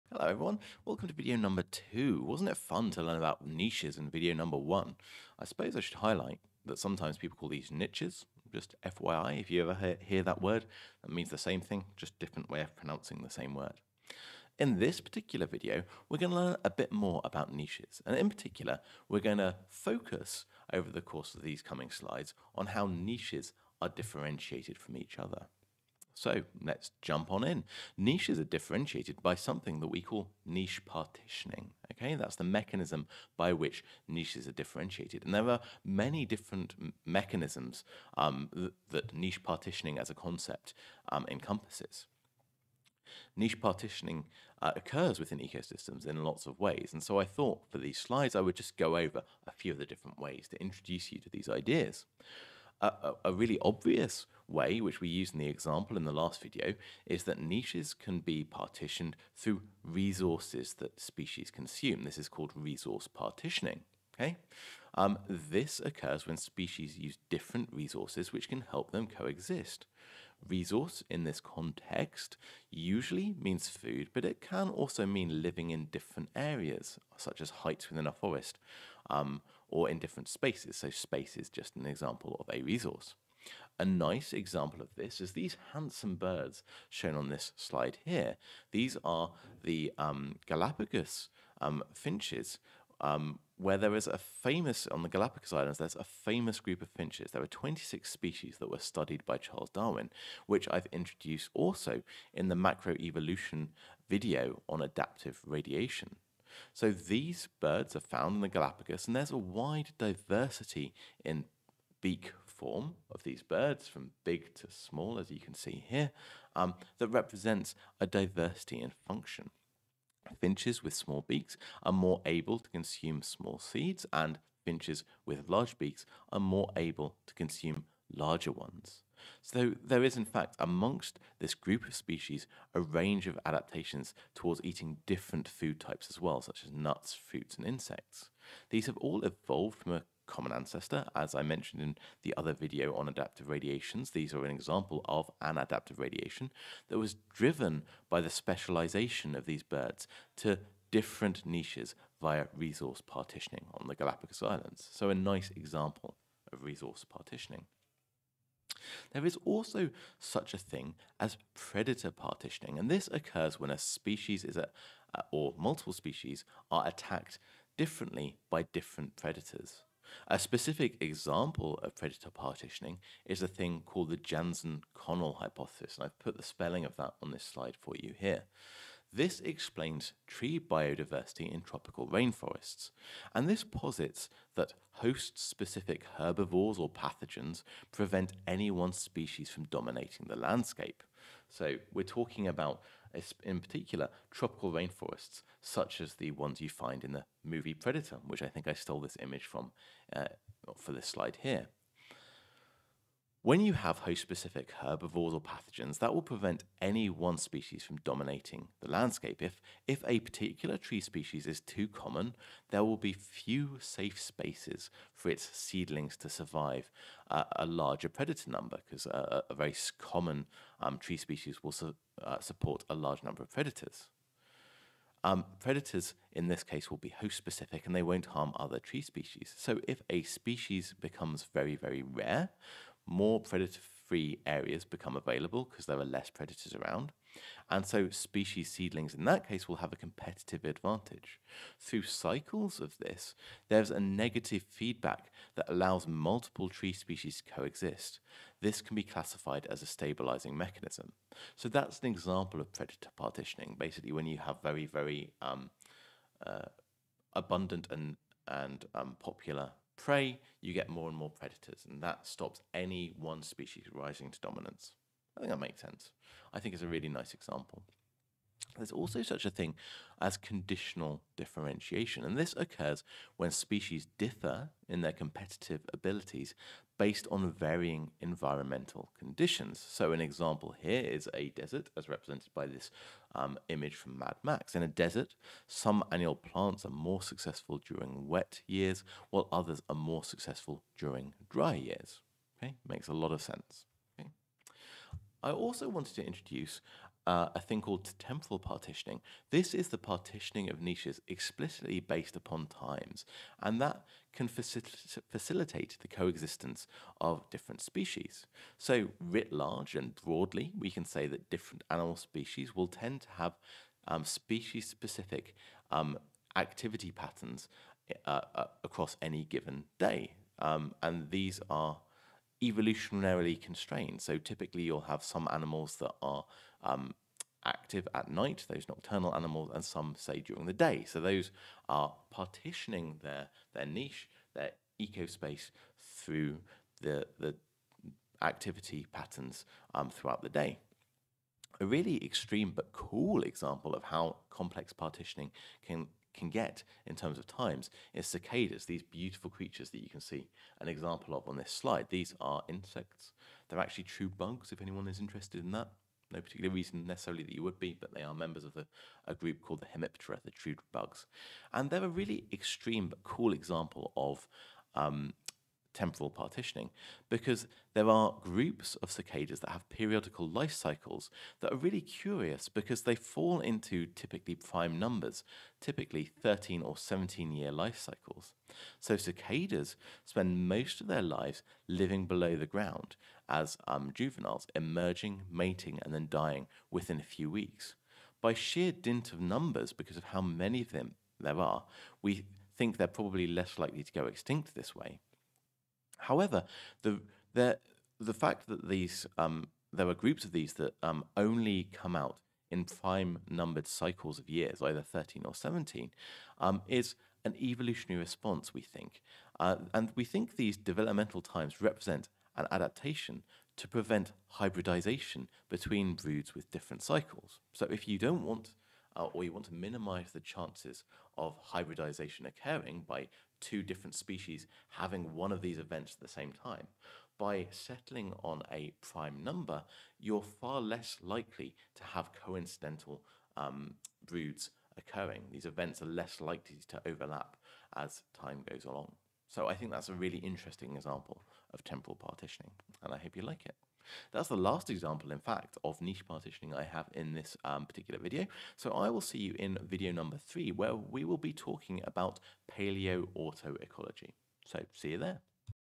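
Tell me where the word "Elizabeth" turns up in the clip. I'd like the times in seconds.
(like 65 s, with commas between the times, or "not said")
not said.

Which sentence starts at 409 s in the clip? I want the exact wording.
Uh, and we think these developmental times represent an adaptation to prevent hybridization between broods with different cycles.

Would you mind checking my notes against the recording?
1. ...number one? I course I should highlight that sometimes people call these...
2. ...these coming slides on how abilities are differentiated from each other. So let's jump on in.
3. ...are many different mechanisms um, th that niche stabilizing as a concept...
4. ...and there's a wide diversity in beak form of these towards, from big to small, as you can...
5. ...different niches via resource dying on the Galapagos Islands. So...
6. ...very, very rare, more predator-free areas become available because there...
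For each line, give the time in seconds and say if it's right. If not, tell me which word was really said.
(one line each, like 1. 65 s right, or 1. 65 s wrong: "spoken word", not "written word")
1. 4 s wrong: "suppose", not "course"
2. 21 s wrong: "niches", not "abilities"
3. 35 s wrong: "partitioning", not "stabilizing"
4. 109 s wrong: "birds", not "towards"
5. 150 s wrong: "partitioning", not "dying"
6. 231 s right.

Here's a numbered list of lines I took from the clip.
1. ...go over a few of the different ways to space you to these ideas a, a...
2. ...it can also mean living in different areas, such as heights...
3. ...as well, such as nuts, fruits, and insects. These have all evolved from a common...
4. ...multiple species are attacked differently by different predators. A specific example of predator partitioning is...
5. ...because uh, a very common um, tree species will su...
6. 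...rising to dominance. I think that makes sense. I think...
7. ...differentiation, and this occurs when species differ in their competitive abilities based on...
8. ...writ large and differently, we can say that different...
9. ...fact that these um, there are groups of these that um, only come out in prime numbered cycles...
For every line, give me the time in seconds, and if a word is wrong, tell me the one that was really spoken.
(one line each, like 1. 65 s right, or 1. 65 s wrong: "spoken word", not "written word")
1. 48 s wrong: "introduce", not "space"
2. 74 s right
3. 136 s right
4. 165 s right
5. 218 s right
6. 263 s right
7. 271 s right
8. 309 s wrong: "broadly", not "differently"
9. 398 s right.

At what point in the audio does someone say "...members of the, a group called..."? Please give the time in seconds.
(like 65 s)
358 s.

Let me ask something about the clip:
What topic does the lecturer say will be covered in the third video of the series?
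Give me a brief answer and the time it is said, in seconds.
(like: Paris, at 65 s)
Paleo-autoecology, at 452 s.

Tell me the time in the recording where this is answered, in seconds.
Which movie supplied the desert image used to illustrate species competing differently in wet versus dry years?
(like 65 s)
284 s.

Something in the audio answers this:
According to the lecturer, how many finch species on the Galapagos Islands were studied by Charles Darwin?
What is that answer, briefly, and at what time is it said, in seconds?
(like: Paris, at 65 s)
26, at 97 s.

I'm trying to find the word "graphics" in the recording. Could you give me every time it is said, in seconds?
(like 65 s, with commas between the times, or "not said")
not said.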